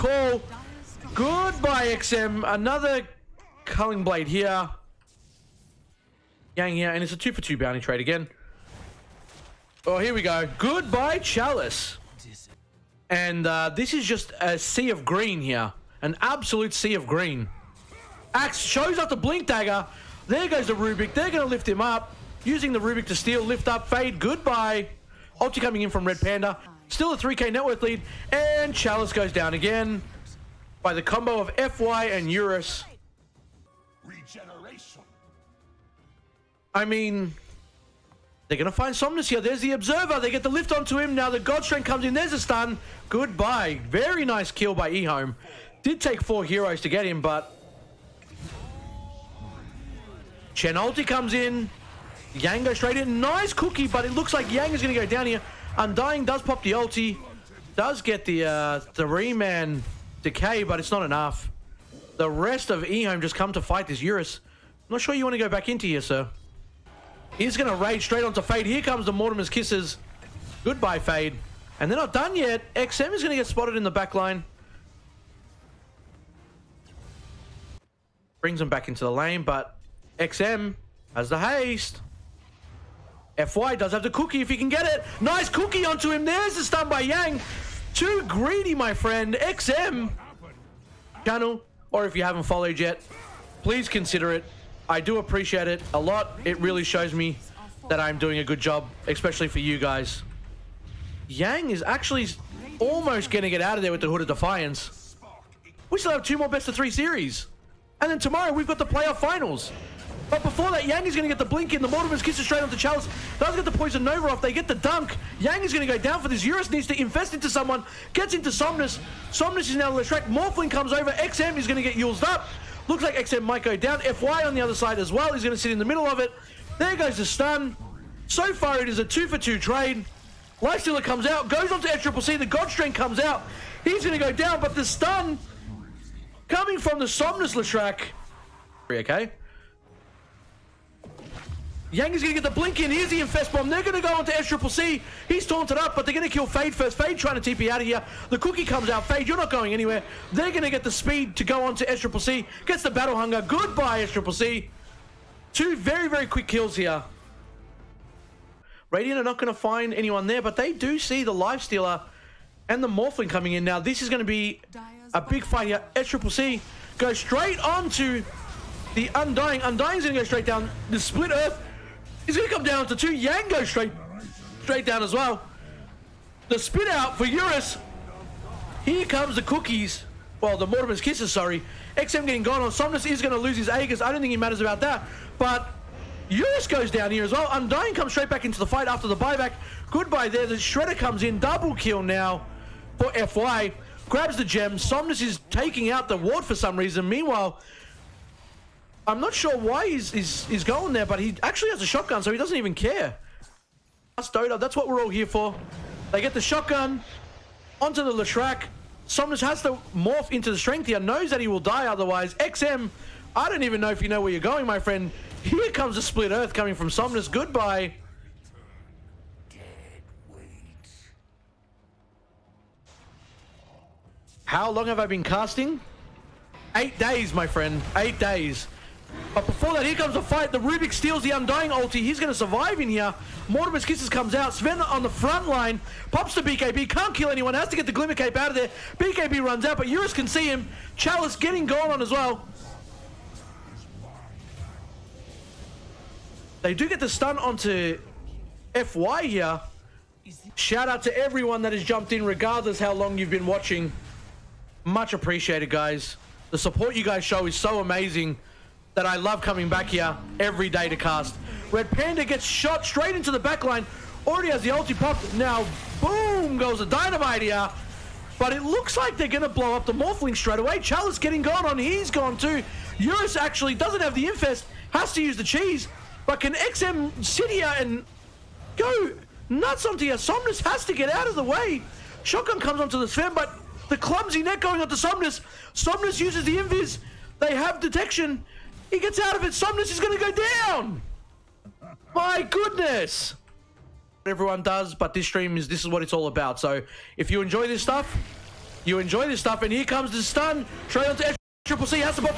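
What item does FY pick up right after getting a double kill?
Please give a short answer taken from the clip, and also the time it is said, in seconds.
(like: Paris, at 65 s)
Gem, at 194 s.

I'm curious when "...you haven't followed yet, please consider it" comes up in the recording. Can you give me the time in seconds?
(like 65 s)
92 s.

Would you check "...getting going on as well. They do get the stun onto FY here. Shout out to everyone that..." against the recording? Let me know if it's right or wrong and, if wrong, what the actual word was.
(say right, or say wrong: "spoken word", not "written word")
right.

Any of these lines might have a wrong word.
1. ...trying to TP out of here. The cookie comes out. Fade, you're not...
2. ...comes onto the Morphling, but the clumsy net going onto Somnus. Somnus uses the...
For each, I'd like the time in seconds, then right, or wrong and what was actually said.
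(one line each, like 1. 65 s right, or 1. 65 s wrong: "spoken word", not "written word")
1. 147 s right
2. 282 s wrong: "Sven", not "Morphling".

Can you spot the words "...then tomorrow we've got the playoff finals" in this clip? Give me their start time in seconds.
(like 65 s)
108 s.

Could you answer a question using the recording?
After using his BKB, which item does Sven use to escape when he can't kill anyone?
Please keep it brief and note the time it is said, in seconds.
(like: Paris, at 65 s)
Glimmer Cape, at 237 s.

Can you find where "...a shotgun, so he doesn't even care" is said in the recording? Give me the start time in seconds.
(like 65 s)
201 s.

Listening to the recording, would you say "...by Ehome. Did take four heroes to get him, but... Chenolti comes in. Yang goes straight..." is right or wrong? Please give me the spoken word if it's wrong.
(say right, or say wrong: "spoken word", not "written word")
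right.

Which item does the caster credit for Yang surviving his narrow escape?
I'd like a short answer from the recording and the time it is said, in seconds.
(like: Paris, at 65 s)
Hood of Defiance, at 104 s.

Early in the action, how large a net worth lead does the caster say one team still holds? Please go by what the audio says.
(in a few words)
3k.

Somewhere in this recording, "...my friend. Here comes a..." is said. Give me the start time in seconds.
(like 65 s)
214 s.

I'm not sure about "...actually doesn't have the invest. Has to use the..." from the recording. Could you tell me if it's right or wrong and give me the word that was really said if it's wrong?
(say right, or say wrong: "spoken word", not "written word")
wrong: "infest", not "invest".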